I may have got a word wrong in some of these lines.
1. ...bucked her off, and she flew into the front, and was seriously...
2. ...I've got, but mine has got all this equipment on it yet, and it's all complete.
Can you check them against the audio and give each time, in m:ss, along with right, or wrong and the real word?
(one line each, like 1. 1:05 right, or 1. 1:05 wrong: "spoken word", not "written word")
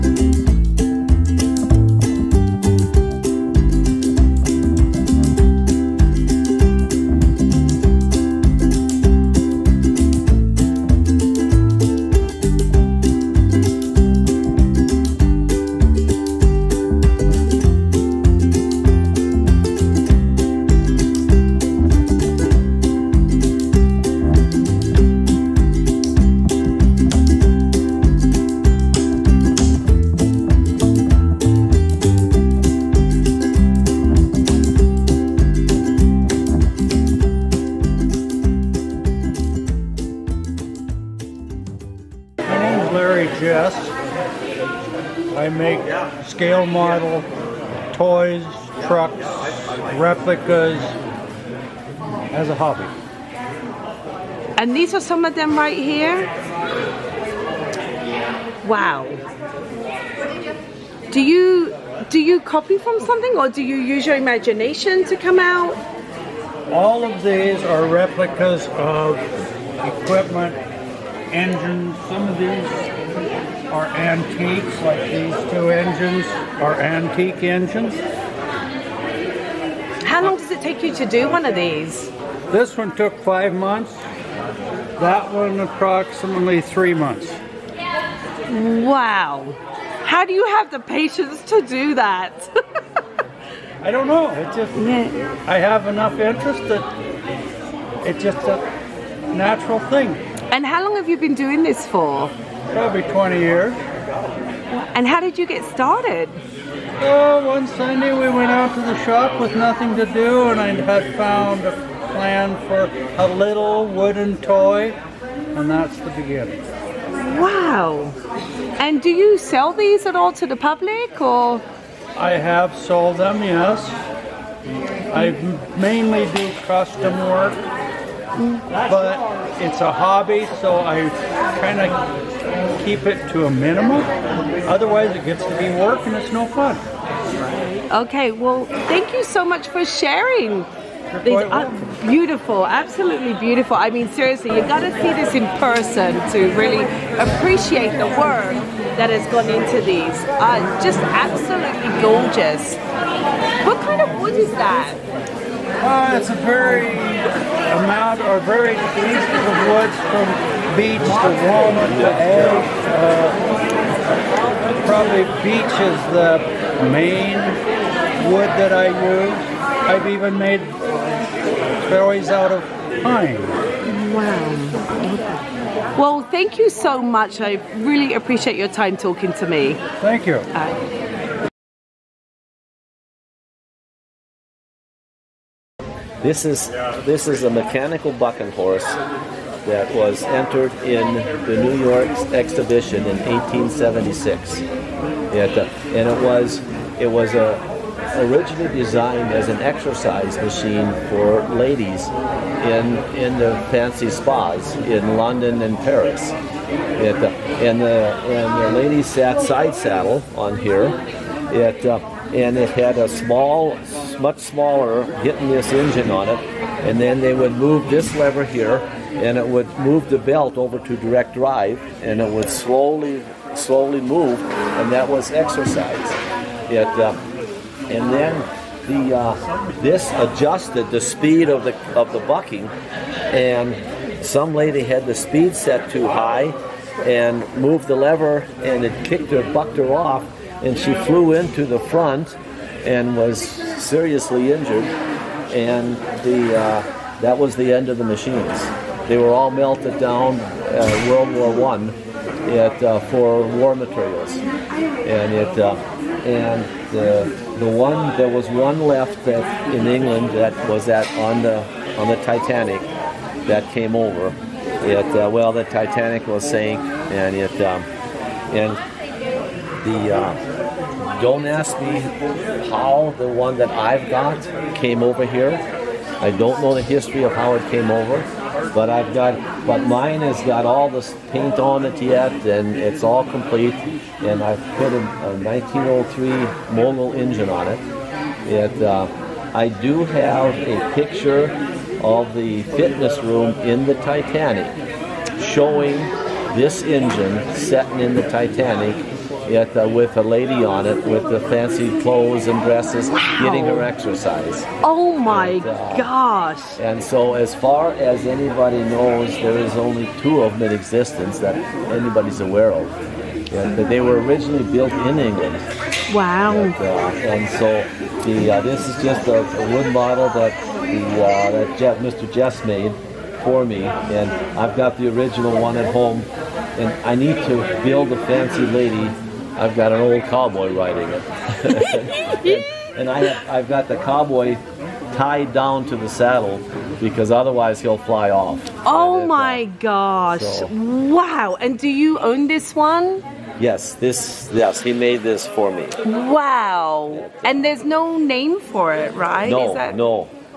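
1. 3:59 right
2. 4:38 wrong: "paint", not "equipment".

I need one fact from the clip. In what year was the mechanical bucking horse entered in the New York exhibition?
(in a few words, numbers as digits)
1876.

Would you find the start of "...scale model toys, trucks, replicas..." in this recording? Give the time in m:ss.
0:46.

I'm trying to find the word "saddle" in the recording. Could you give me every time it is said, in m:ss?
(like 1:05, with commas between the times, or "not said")
3:29, 5:36.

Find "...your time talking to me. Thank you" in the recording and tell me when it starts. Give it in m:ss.
2:58.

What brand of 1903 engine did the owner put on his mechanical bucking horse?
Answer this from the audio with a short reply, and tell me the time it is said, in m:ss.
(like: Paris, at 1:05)
Mogul, at 4:46.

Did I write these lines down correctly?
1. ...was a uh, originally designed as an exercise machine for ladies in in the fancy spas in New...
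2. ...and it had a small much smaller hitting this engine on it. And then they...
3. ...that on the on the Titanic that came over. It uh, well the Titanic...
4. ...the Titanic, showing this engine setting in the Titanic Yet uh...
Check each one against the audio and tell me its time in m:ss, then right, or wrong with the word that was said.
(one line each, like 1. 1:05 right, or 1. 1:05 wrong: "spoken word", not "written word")
1. 3:17 wrong: "London", not "New"
2. 3:32 right
3. 4:20 right
4. 4:53 right.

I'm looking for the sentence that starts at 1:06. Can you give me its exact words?
All of these are replicas of equipment, engines, some of these are antiques, like these two engines are antique engines.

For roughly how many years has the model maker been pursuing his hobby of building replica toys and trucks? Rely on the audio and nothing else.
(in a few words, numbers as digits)
20 years.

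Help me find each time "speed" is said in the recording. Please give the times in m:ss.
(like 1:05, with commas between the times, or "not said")
3:51, 3:55.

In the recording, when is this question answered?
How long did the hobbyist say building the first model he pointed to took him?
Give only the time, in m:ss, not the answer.
1:23.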